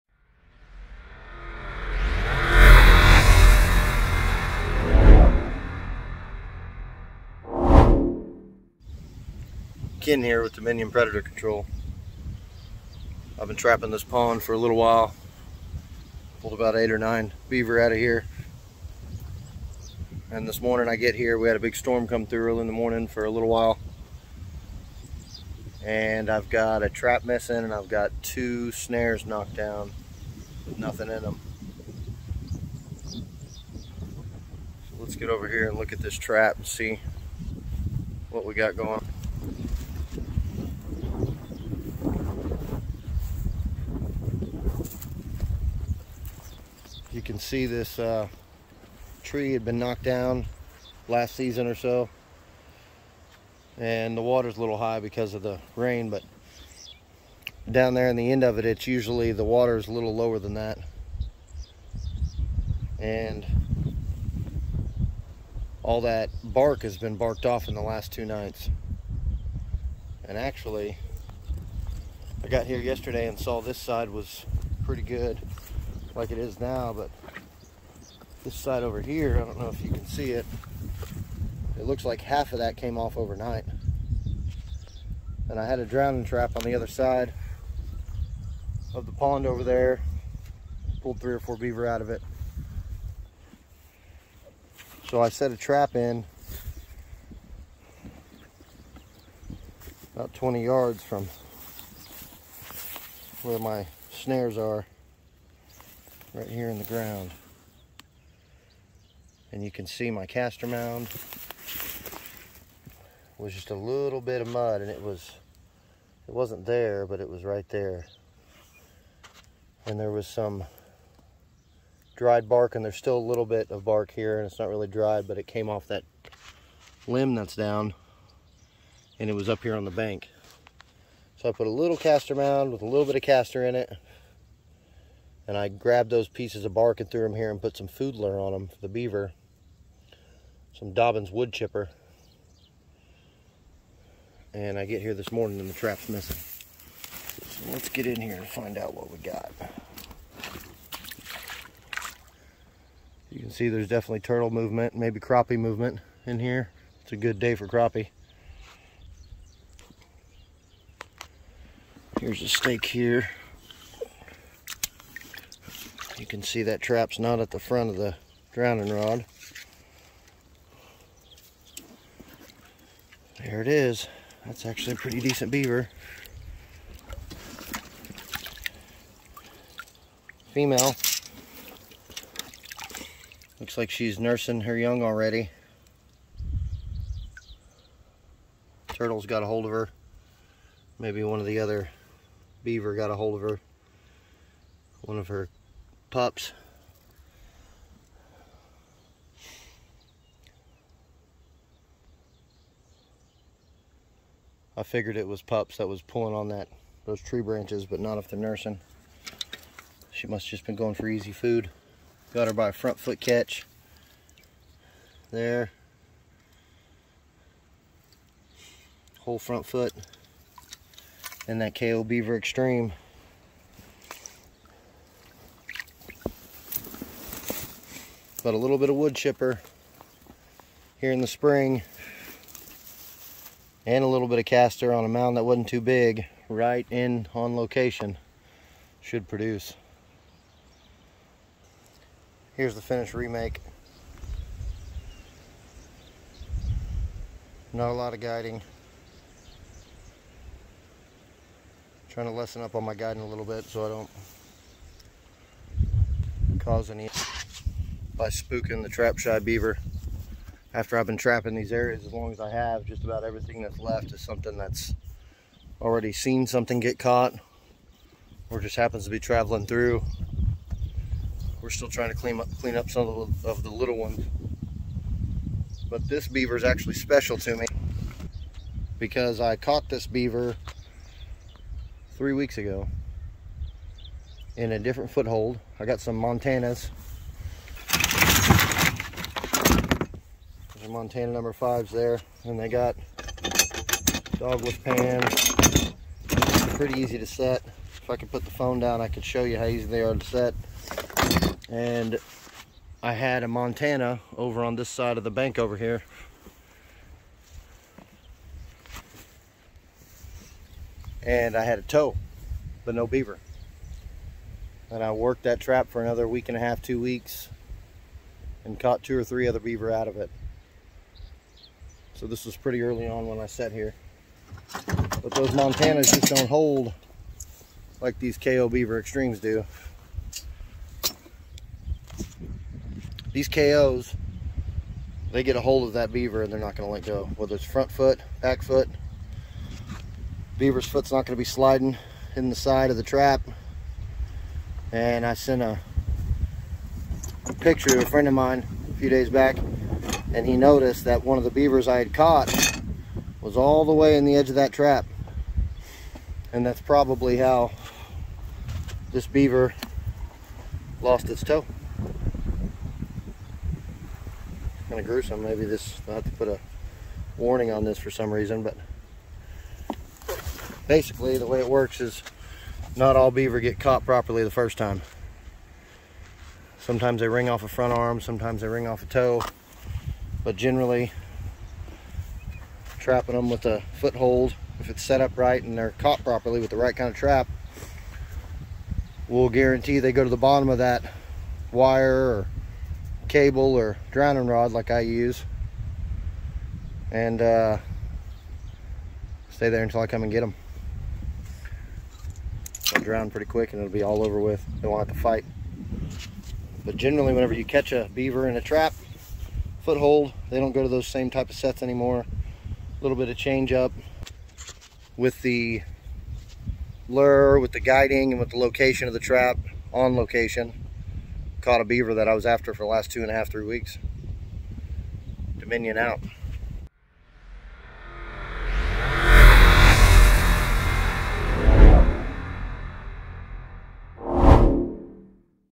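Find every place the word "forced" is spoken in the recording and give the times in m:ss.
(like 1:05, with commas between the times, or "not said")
not said.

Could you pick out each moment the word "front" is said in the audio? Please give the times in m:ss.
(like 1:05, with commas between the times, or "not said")
2:47, 3:32, 3:39, 5:37, 6:17.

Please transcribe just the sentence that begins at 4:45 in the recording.
I got some Montanas Montana number fives there.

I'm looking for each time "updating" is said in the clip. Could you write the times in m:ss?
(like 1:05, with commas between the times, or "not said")
not said.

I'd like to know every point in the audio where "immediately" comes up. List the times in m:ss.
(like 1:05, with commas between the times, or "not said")
not said.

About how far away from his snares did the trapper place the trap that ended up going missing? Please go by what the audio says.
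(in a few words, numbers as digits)
20 yards.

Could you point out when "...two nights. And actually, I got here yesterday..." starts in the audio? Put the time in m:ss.
1:08.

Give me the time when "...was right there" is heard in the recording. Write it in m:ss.
1:57.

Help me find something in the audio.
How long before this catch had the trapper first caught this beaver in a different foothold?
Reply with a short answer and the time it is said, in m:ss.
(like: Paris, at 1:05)
3 weeks, at 4:42.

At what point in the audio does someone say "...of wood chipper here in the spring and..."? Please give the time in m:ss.
3:48.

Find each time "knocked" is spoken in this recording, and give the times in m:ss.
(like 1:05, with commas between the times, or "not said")
0:29, 0:49.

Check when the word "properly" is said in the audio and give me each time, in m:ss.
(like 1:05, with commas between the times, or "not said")
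6:14, 6:26.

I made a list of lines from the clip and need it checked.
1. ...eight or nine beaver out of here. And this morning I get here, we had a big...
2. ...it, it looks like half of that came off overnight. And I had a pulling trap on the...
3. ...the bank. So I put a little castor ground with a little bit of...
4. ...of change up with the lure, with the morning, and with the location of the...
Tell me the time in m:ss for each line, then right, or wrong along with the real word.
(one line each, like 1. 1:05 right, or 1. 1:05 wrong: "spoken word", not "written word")
1. 0:16 right
2. 1:20 wrong: "drowning", not "pulling"
3. 2:09 wrong: "mound", not "ground"
4. 6:53 wrong: "guiding", not "morning".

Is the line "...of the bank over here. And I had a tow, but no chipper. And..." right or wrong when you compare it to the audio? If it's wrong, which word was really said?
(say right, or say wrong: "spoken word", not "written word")
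wrong: "beaver", not "chipper".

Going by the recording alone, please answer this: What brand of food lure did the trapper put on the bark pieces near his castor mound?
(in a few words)
Dobbins wood chipper.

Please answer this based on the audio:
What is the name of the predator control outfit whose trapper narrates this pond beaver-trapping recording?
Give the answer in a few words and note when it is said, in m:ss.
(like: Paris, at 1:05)
Dominion Predator Control, at 0:10.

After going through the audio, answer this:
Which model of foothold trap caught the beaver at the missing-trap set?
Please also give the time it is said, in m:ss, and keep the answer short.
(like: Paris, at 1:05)
KO Beaver Extreme, at 3:41.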